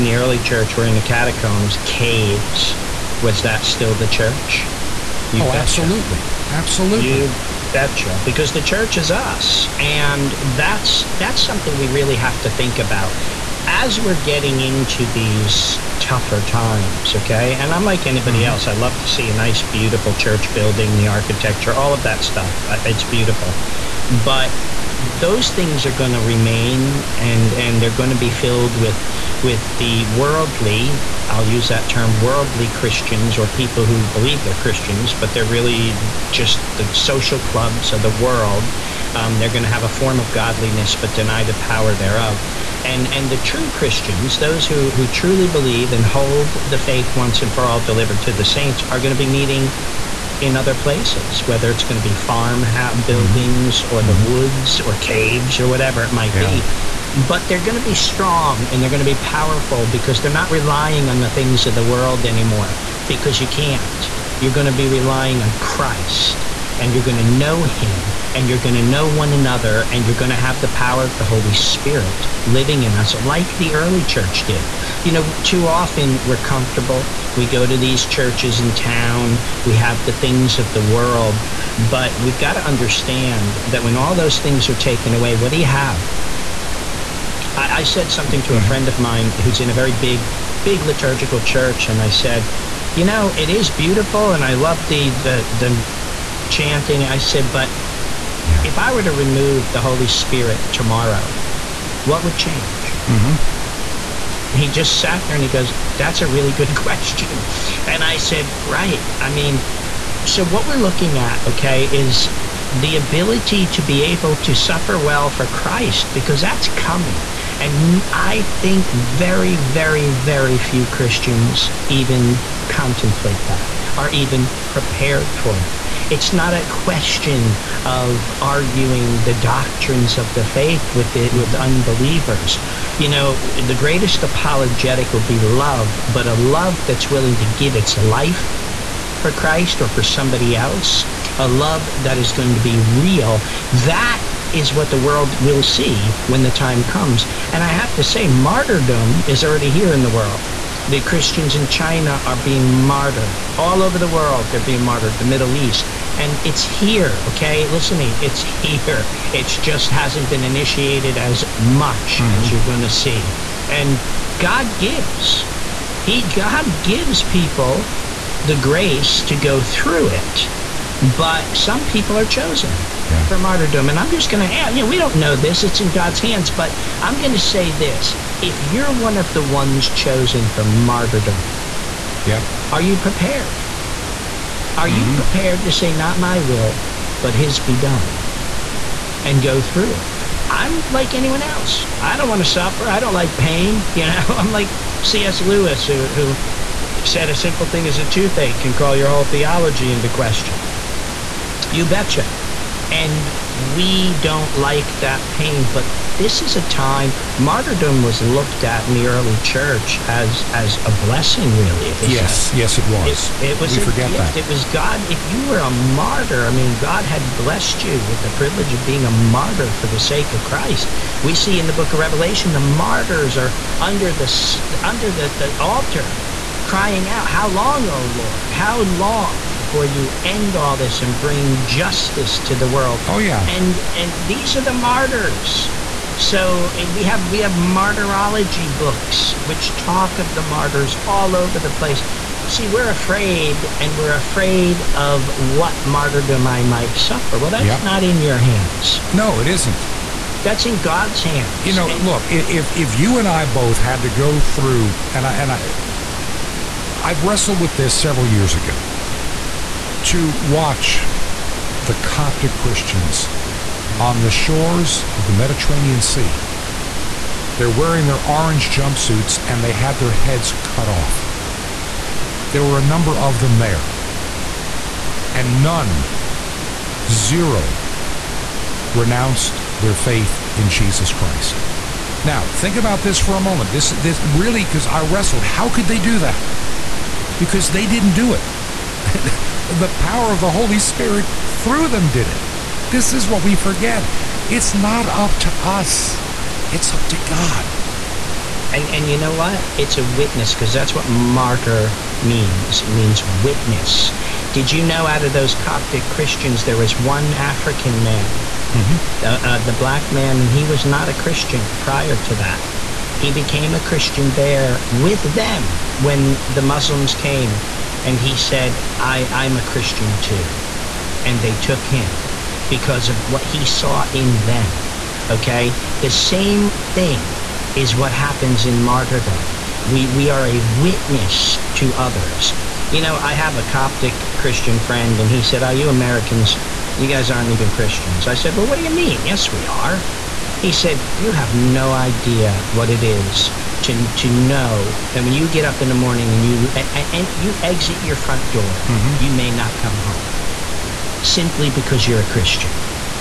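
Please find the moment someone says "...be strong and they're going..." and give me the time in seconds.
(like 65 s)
57 s.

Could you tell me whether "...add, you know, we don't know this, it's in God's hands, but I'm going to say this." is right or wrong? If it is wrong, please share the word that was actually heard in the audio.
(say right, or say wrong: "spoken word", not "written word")
right.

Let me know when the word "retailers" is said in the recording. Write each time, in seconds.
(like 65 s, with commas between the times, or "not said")
not said.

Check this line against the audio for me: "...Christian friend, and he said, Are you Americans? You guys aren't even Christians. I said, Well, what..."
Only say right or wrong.
right.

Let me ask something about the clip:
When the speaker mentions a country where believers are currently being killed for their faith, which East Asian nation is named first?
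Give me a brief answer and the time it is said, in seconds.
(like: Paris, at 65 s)
China, at 151 s.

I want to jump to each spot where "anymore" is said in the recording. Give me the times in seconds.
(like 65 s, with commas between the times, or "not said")
62 s.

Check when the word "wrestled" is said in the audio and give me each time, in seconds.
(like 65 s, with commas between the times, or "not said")
257 s, 285 s.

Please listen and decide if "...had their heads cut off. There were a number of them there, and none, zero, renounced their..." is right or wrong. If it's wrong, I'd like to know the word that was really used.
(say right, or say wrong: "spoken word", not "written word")
right.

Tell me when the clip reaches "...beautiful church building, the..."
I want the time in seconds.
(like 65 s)
19 s.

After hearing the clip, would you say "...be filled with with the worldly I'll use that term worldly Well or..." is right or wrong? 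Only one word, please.
wrong.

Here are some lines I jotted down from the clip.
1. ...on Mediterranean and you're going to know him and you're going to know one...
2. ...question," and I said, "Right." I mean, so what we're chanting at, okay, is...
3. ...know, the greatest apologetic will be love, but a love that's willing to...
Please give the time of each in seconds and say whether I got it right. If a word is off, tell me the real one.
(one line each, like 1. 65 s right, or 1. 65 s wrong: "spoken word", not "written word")
1. 65 s wrong: "Christ", not "Mediterranean"
2. 106 s wrong: "looking", not "chanting"
3. 133 s right.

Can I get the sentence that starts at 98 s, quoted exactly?
if I were to remove the Holy Spirit tomorrow, what would change?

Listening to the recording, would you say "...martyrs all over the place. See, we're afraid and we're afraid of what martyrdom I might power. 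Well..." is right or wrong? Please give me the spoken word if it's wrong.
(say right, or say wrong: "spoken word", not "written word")
wrong: "suffer", not "power".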